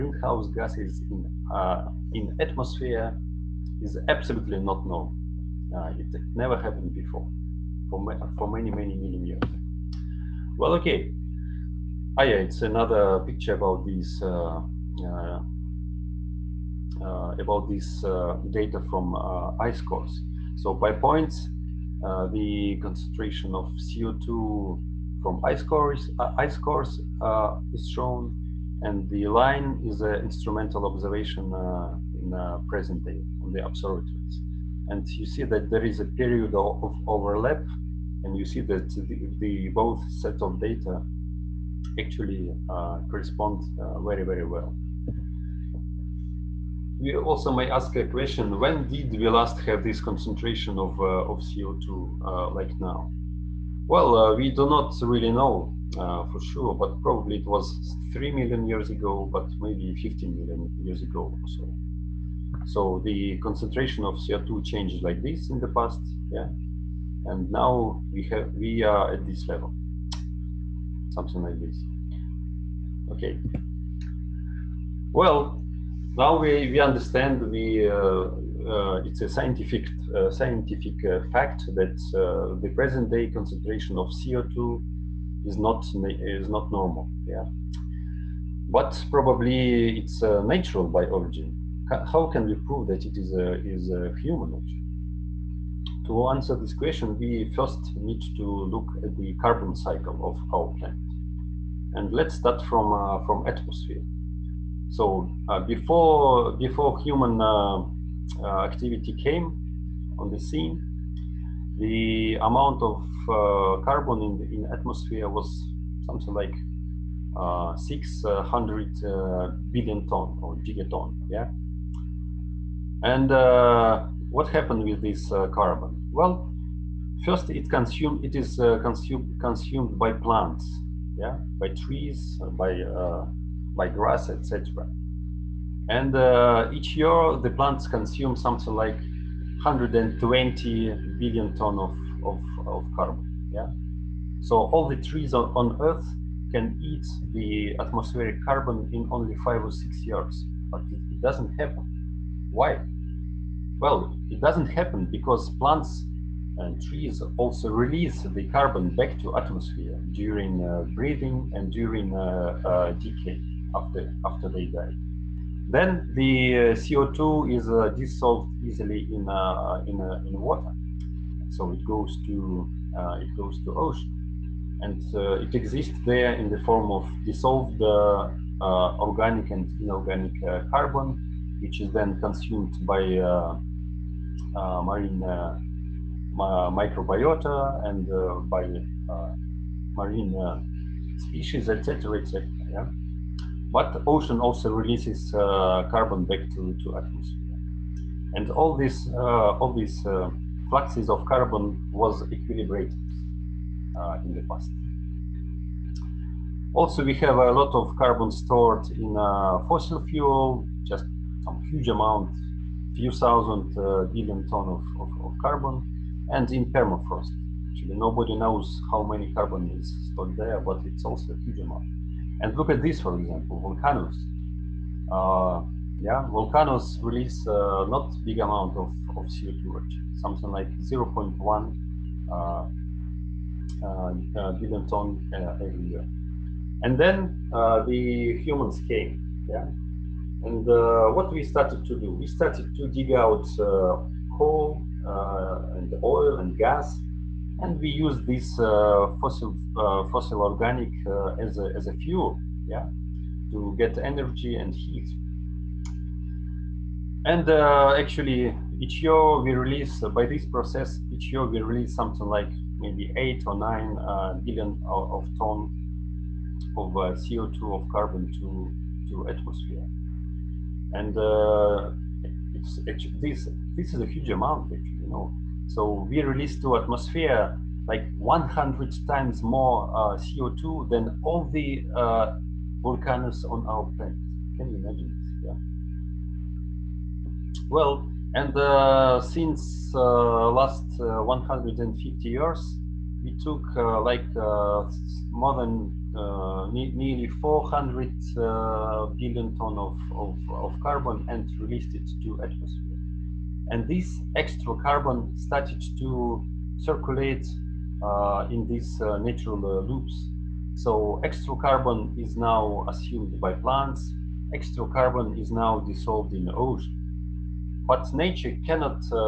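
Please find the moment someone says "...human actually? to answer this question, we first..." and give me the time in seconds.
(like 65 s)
94 s.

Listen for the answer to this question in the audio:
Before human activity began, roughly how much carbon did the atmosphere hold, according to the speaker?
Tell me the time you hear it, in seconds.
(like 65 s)
117 s.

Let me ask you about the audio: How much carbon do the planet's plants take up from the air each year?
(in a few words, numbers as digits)
120 billion tons.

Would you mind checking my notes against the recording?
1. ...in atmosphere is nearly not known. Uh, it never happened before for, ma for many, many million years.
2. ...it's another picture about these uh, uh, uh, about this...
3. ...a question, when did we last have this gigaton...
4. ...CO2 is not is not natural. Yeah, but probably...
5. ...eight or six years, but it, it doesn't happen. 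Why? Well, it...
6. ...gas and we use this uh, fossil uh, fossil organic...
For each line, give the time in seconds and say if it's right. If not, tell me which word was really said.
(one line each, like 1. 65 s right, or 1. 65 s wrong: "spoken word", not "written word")
1. 2 s wrong: "absolutely", not "nearly"
2. 12 s right
3. 47 s wrong: "concentration", not "gigaton"
4. 84 s wrong: "normal", not "natural"
5. 149 s wrong: "five", not "eight"
6. 246 s right.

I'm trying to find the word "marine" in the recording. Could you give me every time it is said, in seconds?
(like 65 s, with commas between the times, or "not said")
184 s, 189 s.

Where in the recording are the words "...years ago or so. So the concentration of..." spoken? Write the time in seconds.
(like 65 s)
60 s.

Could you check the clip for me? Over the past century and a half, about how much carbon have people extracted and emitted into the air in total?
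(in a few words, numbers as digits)
nearly 400 billion tons.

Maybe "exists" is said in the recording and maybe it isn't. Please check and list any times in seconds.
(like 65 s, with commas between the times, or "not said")
175 s.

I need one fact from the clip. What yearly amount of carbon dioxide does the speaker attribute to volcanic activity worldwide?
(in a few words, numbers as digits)
0.1 billion tons.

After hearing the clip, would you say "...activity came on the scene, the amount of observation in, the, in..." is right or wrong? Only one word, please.
wrong.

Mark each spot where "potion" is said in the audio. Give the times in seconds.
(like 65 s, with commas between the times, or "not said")
not said.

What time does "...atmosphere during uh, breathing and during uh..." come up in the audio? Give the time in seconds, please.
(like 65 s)
159 s.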